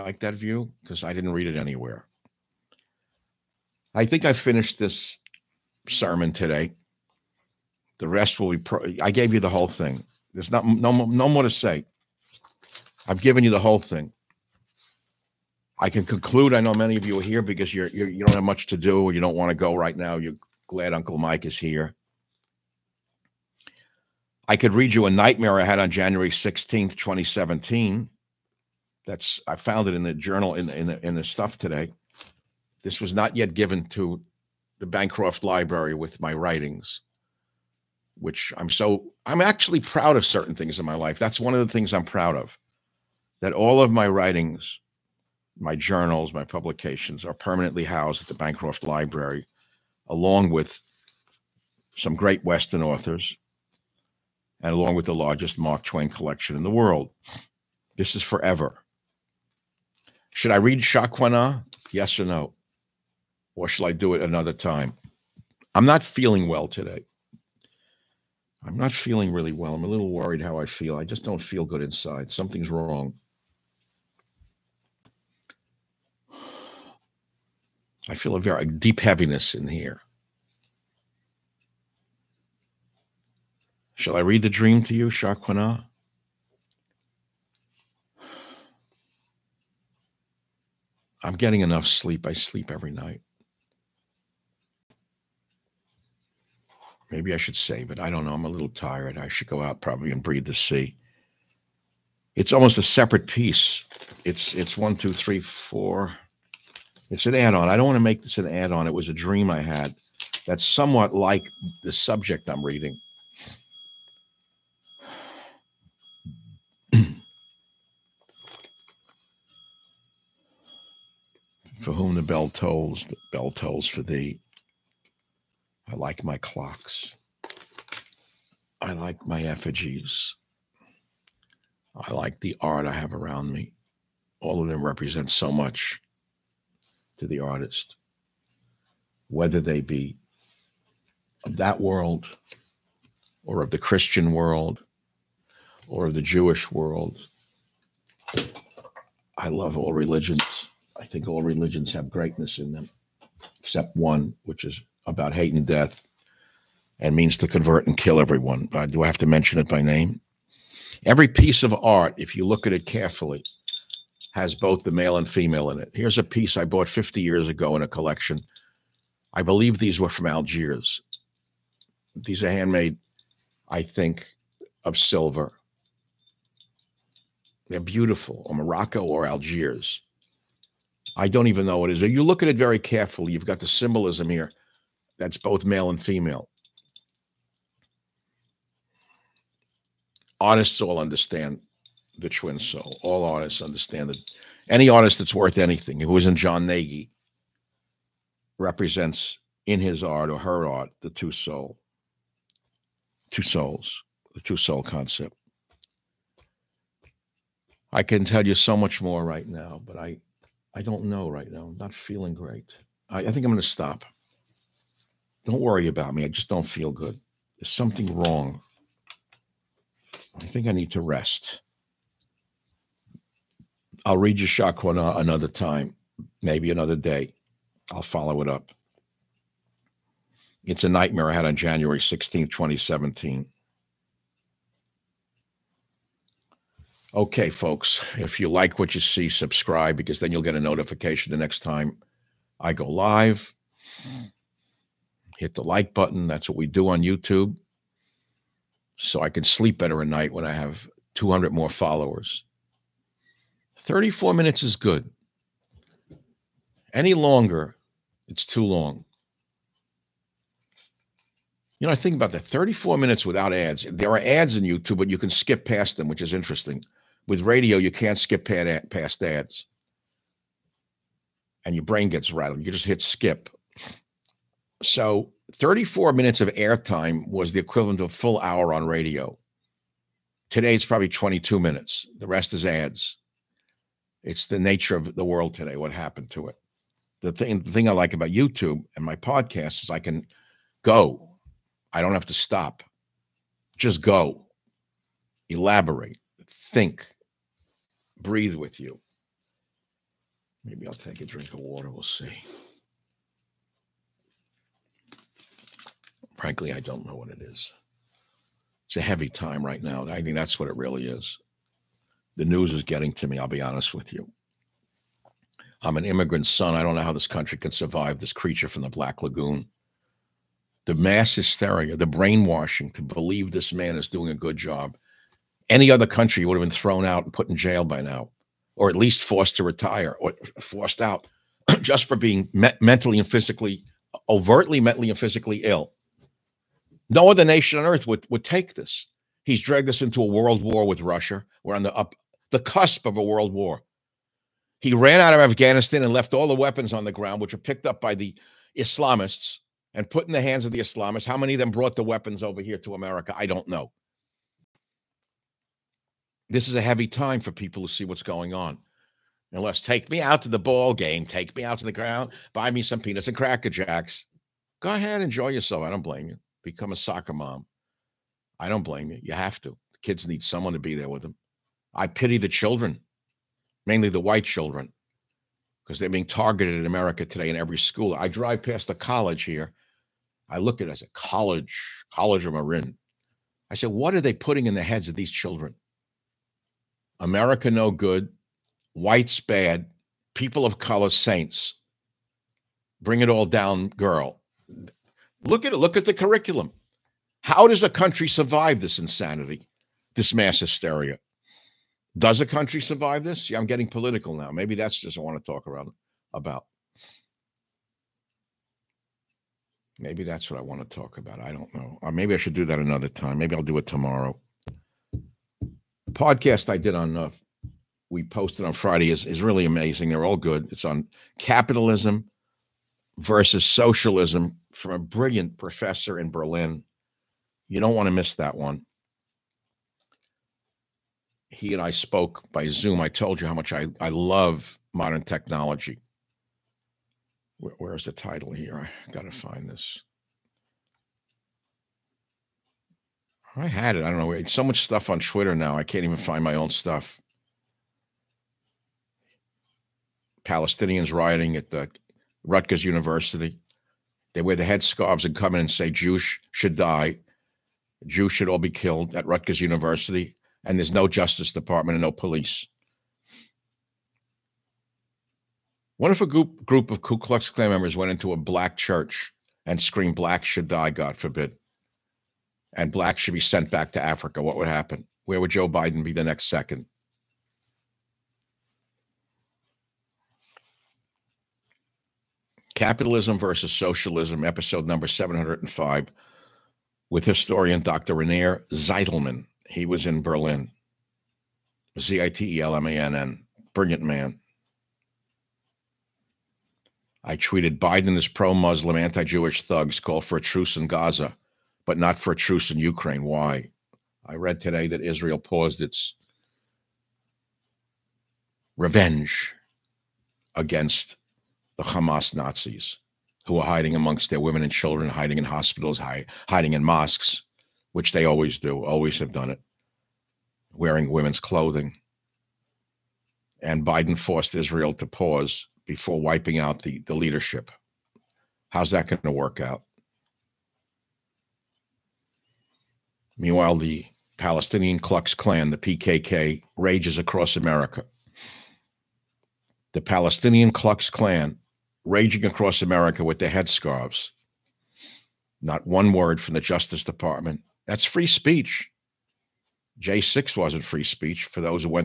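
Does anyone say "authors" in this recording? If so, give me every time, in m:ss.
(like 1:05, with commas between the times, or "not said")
0:52.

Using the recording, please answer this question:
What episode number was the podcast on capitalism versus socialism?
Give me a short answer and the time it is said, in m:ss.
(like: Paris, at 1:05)
705, at 8:04.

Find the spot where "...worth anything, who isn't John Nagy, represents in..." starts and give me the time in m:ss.
3:15.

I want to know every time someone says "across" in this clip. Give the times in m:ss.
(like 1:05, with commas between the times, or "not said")
8:57, 9:02.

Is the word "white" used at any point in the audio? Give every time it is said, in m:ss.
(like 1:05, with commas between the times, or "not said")
6:14, 6:28.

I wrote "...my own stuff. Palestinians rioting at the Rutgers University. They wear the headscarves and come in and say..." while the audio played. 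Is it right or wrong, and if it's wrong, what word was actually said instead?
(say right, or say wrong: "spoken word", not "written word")
right.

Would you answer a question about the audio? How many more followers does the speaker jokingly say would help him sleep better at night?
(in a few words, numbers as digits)
200.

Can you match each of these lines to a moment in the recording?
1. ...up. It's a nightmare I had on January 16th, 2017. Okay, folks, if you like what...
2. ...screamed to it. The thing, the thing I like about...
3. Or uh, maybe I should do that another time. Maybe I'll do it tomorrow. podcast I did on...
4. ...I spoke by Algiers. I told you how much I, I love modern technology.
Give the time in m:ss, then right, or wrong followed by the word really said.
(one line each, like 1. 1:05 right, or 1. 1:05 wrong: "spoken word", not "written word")
1. 3:48 right
2. 4:45 wrong: "happened", not "screamed"
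3. 6:52 right
4. 7:11 wrong: "Zoom", not "Algiers".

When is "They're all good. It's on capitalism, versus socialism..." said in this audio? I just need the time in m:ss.
7:00.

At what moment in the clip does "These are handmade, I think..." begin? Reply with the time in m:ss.
2:52.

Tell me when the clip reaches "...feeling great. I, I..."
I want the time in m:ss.
3:31.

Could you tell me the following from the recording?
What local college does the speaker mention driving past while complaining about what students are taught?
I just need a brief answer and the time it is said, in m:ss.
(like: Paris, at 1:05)
College of Marin, at 6:22.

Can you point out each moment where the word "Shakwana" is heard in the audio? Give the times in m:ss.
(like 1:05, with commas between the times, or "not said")
1:25, 3:44.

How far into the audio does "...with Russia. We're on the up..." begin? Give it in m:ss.
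5:40.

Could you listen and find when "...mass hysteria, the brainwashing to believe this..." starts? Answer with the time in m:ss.
5:20.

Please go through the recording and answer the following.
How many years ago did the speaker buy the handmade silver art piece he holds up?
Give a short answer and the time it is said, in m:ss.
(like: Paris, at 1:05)
50, at 2:46.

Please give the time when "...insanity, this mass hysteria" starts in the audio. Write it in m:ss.
6:38.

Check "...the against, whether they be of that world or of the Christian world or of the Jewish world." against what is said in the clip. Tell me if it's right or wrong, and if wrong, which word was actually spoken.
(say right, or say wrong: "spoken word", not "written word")
wrong: "artist", not "against".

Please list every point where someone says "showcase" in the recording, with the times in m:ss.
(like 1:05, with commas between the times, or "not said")
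not said.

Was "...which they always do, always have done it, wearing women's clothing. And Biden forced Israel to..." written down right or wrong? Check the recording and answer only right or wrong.
right.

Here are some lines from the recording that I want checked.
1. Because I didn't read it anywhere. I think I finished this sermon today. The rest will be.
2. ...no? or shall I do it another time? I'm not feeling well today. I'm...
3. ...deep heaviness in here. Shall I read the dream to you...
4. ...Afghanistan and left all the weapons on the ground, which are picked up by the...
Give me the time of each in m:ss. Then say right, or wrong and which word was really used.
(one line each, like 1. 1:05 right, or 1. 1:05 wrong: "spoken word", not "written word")
1. 0:00 right
2. 1:02 right
3. 1:18 right
4. 5:45 right.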